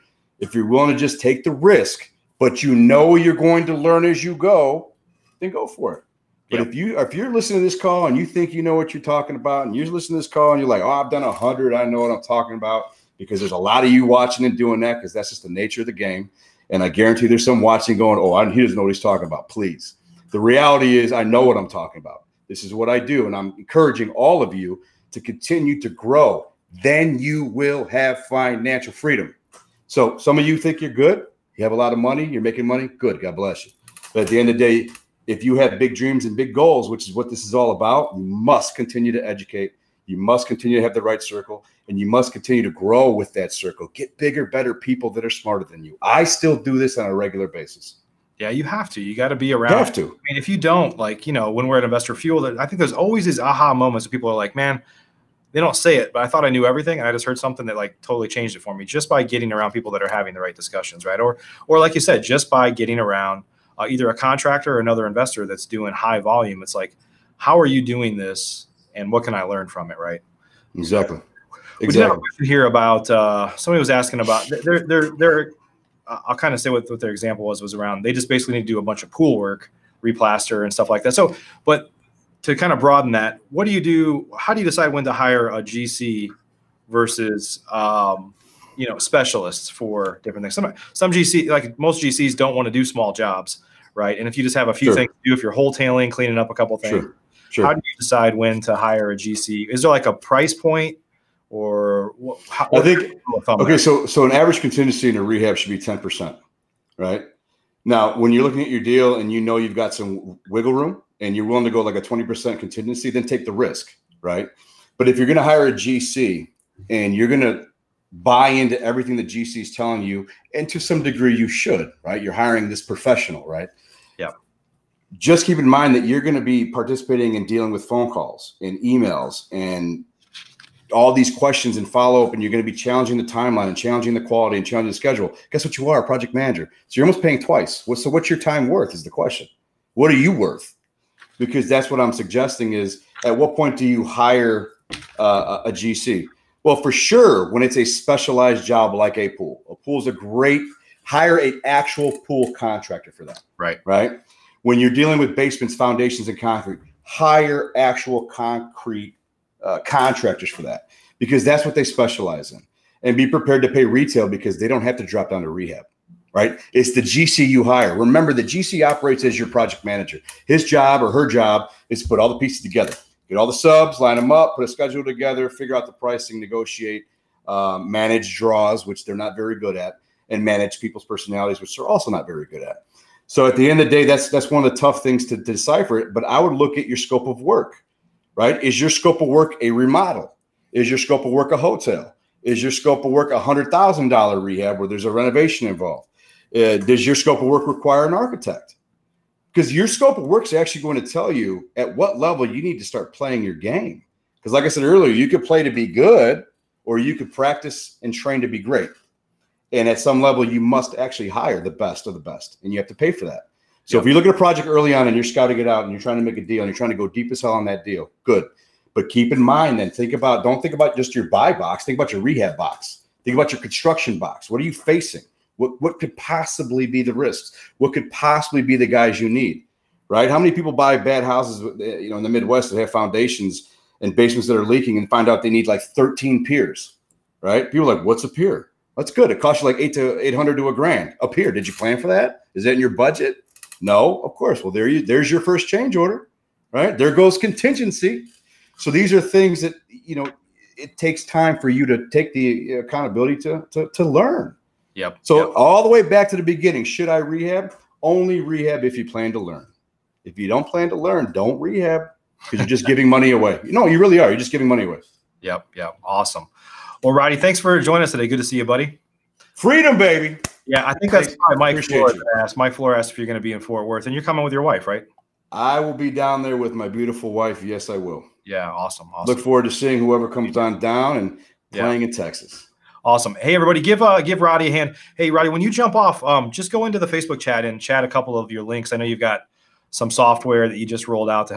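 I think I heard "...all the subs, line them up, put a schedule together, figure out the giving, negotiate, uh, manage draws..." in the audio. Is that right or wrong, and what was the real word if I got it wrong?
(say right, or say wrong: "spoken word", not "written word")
wrong: "pricing", not "giving".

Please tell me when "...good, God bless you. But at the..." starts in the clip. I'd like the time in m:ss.
0:32.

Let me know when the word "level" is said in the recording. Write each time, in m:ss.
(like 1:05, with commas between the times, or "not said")
3:22, 3:30.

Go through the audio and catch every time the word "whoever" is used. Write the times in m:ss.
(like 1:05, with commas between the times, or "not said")
4:39.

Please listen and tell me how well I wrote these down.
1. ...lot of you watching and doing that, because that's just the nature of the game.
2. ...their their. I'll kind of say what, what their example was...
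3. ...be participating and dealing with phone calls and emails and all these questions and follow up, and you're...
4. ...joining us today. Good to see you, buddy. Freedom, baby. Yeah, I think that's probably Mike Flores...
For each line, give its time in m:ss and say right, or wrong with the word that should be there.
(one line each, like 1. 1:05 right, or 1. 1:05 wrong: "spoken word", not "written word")
1. 0:13 right
2. 1:14 right
3. 2:06 right
4. 4:27 right.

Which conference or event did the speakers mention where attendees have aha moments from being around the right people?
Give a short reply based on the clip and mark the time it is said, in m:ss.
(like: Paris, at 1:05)
Investor Fuel, at 0:51.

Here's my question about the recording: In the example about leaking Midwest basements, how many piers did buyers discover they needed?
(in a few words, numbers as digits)
13.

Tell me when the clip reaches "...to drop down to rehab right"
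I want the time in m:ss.
2:44.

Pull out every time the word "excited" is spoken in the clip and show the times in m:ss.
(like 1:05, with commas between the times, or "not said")
not said.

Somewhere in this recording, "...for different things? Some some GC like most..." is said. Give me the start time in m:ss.
1:29.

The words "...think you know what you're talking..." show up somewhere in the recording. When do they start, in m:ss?
0:08.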